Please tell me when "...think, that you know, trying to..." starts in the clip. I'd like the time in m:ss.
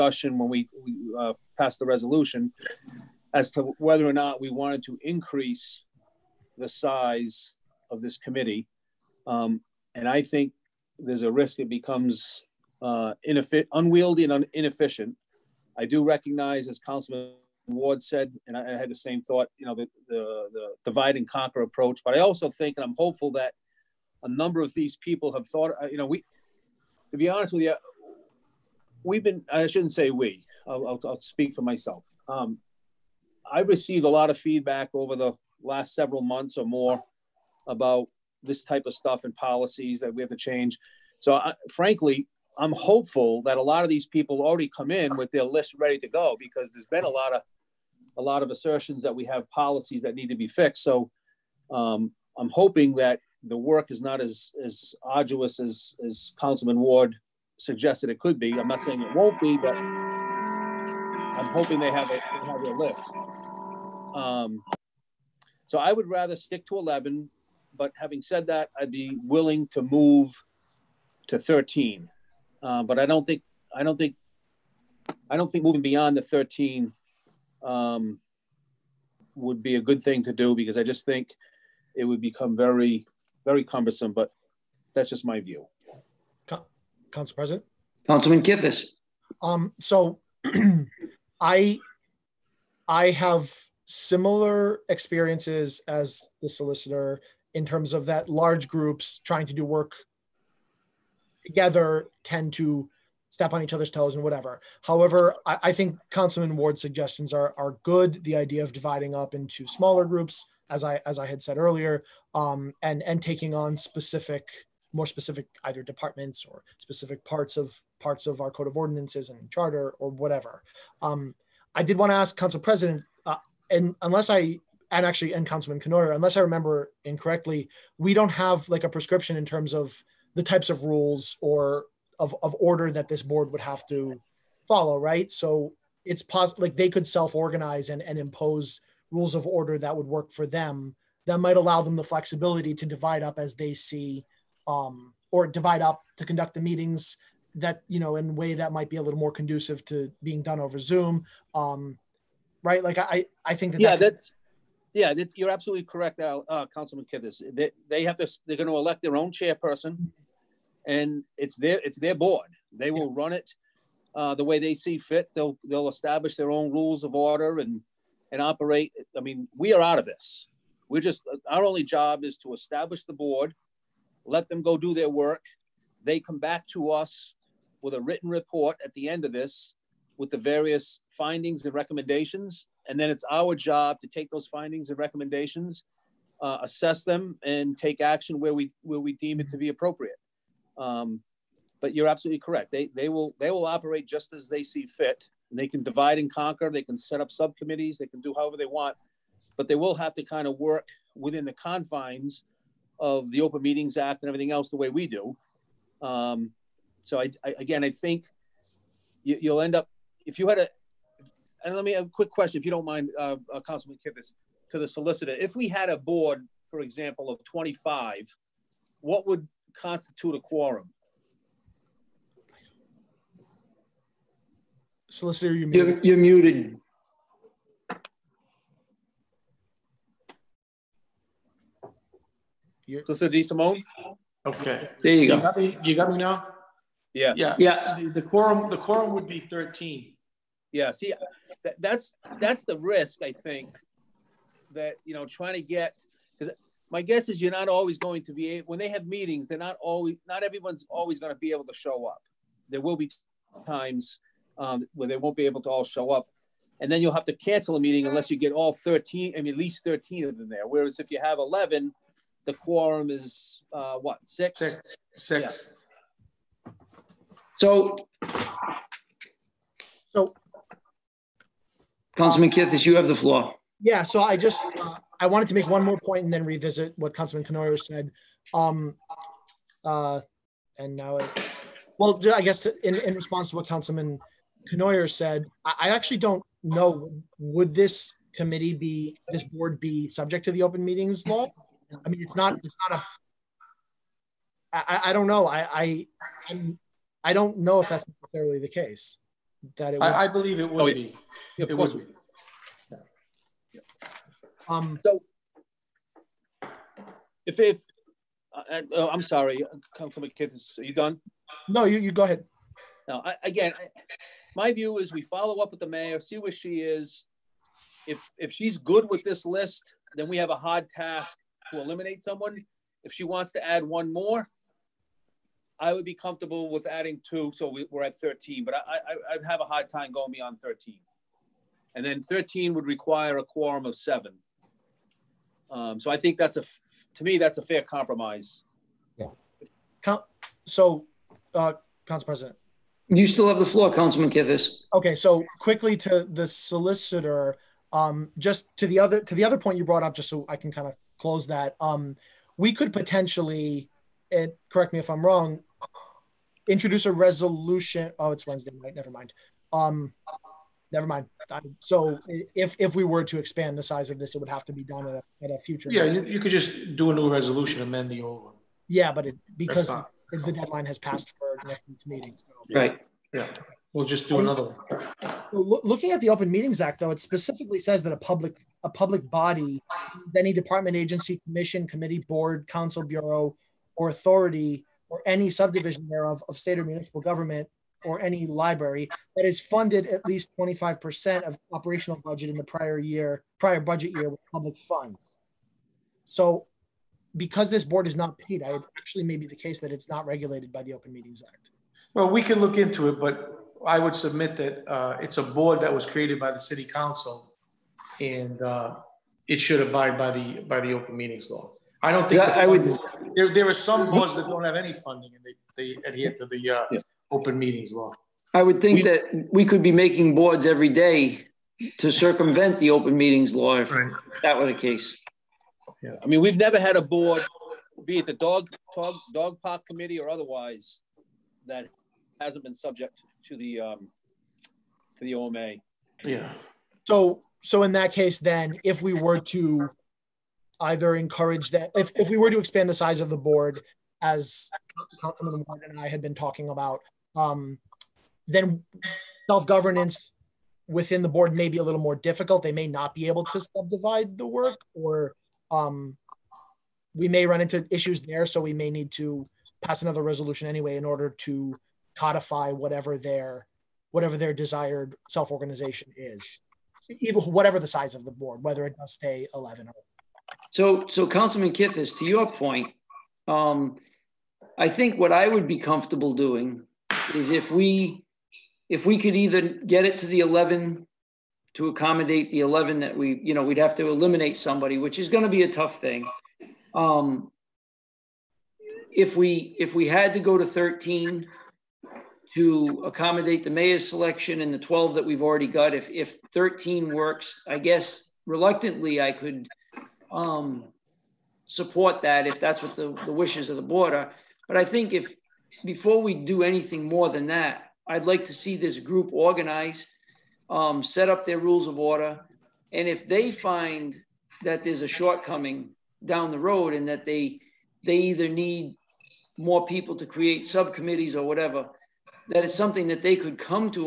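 4:03.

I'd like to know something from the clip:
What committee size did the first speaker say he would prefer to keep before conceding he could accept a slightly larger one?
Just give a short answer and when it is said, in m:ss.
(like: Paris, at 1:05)
11, at 1:05.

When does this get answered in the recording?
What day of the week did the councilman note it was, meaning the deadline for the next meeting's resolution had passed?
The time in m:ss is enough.
5:58.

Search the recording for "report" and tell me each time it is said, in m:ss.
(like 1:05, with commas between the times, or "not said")
2:58.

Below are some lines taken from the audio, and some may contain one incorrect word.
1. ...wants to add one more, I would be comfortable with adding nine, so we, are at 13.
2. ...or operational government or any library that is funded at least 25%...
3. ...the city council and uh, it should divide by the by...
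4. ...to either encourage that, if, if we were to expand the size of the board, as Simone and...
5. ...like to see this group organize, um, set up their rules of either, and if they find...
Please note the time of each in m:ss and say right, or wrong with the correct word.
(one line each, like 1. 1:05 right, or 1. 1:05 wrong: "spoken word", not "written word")
1. 5:23 wrong: "two", not "nine"
2. 6:26 wrong: "municipal", not "operational"
3. 6:46 wrong: "abide", not "divide"
4. 7:19 wrong: "Councilman", not "Simone"
5. 8:28 wrong: "order", not "either".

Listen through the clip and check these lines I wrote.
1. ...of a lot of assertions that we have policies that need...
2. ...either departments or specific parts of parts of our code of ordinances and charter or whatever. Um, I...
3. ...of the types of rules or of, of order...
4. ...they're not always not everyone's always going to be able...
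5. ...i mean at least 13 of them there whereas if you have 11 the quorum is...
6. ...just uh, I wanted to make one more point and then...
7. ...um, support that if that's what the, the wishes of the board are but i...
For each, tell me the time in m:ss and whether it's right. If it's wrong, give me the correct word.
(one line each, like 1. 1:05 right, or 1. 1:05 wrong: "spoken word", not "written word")
1. 0:47 right
2. 1:55 right
3. 2:09 right
4. 4:09 right
5. 4:19 right
6. 4:34 right
7. 8:20 right.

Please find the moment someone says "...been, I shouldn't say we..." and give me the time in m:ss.
0:29.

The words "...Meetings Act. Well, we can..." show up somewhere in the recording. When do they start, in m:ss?
6:41.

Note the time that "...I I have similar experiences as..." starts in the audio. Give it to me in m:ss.
1:31.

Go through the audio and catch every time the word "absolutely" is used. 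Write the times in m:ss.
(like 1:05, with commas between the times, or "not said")
2:35, 3:12.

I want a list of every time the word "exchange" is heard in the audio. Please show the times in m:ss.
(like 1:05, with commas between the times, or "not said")
not said.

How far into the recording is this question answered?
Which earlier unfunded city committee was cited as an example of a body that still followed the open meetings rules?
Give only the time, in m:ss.
7:09.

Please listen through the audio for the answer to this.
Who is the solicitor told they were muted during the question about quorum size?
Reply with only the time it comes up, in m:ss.
3:53.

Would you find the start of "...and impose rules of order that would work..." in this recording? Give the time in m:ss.
2:18.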